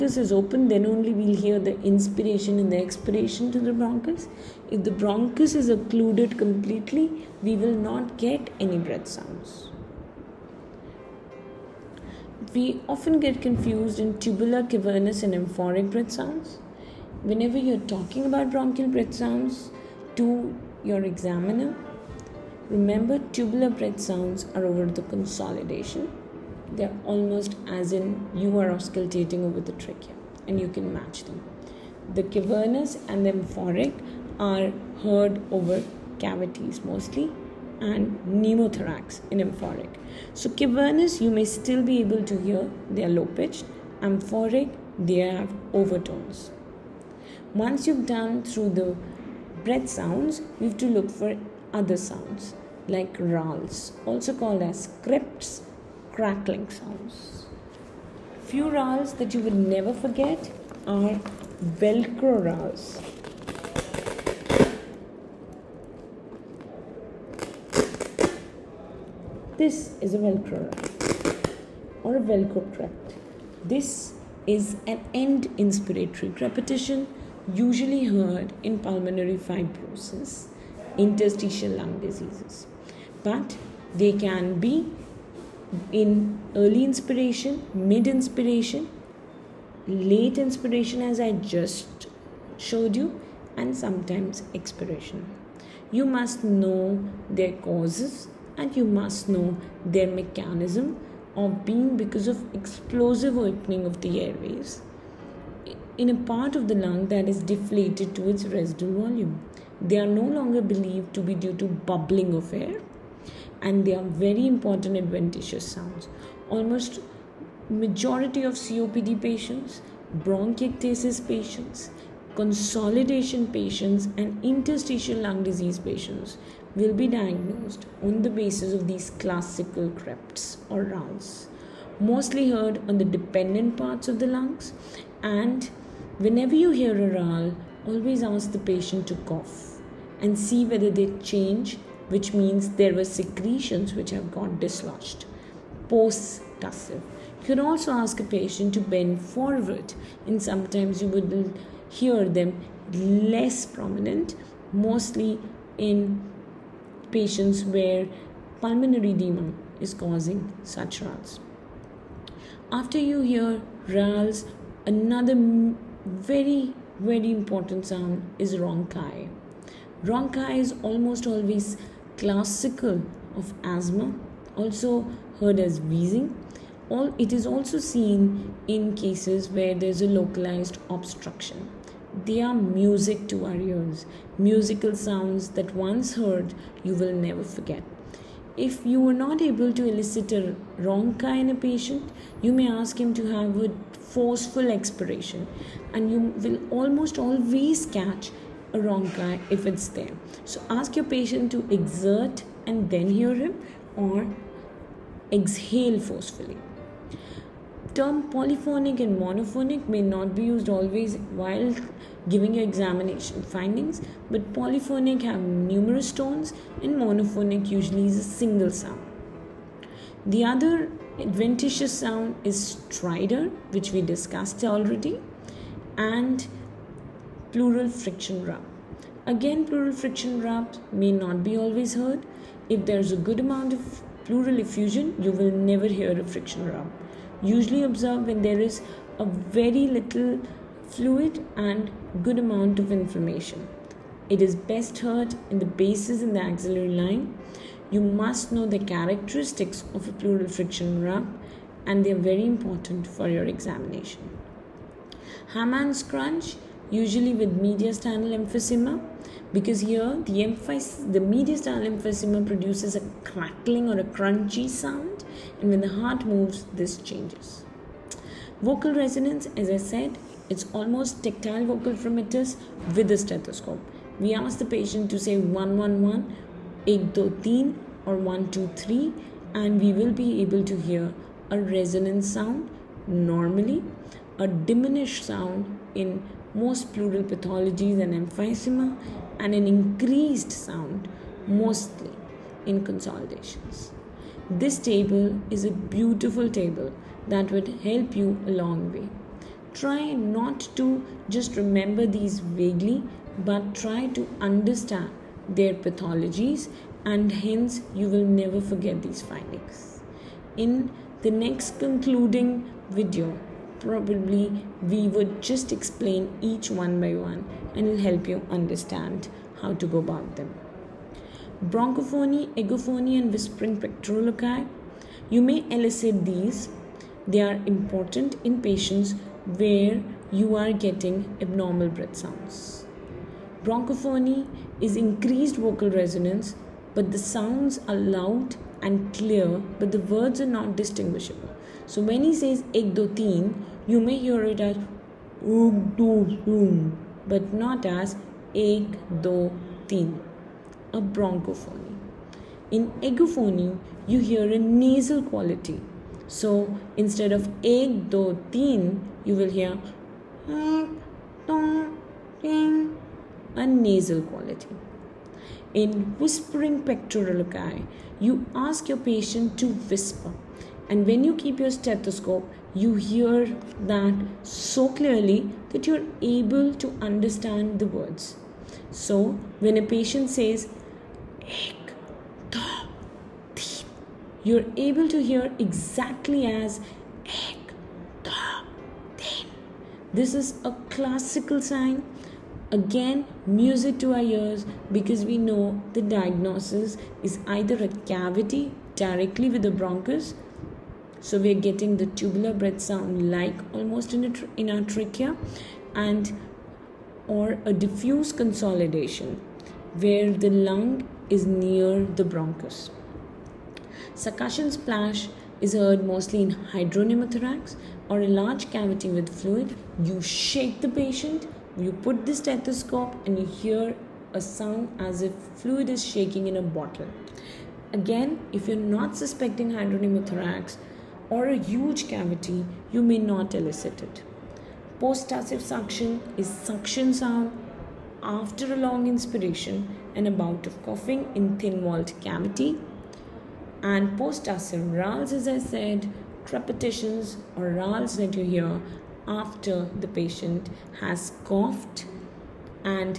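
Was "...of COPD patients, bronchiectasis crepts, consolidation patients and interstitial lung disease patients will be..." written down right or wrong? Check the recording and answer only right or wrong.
wrong.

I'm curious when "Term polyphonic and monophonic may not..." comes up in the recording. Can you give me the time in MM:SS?
03:27.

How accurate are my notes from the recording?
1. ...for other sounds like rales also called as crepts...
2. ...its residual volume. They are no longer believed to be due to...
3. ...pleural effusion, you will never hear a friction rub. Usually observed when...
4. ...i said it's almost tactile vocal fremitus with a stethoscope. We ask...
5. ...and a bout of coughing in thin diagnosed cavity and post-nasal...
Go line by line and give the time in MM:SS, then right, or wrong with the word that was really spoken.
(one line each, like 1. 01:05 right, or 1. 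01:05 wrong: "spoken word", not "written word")
1. 00:51 right
2. 01:48 right
3. 03:54 right
4. 04:29 right
5. 07:20 wrong: "walled", not "diagnosed".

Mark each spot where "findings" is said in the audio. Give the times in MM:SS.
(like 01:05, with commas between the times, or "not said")
03:33, 05:09.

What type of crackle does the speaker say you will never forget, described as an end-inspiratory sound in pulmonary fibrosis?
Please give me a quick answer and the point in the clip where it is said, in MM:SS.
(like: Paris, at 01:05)
Velcro rales, at 01:01.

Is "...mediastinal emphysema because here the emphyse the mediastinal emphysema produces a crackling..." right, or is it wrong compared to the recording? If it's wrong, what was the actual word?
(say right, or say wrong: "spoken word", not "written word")
right.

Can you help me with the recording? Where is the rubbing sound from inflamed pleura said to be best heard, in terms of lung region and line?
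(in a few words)
Bases in the axillary line.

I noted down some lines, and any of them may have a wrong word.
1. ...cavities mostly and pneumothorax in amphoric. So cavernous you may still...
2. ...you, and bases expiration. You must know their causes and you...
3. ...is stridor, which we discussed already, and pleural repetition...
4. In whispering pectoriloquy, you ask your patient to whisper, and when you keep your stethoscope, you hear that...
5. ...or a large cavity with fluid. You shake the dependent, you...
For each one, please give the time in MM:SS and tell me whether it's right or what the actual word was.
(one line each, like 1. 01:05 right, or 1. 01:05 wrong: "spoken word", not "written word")
1. 00:36 right
2. 01:32 wrong: "sometimes", not "bases"
3. 03:42 wrong: "friction", not "repetition"
4. 06:05 right
5. 06:58 wrong: "patient", not "dependent".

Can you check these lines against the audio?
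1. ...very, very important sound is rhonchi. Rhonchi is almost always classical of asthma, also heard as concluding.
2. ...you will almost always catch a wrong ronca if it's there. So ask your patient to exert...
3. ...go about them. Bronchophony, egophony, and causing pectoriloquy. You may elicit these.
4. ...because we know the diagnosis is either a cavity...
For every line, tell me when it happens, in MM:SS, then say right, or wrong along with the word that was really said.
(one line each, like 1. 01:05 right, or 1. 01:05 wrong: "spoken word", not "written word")
1. 02:46 wrong: "wheezing", not "concluding"
2. 03:16 right
3. 05:19 wrong: "whispering", not "causing"
4. 06:34 right.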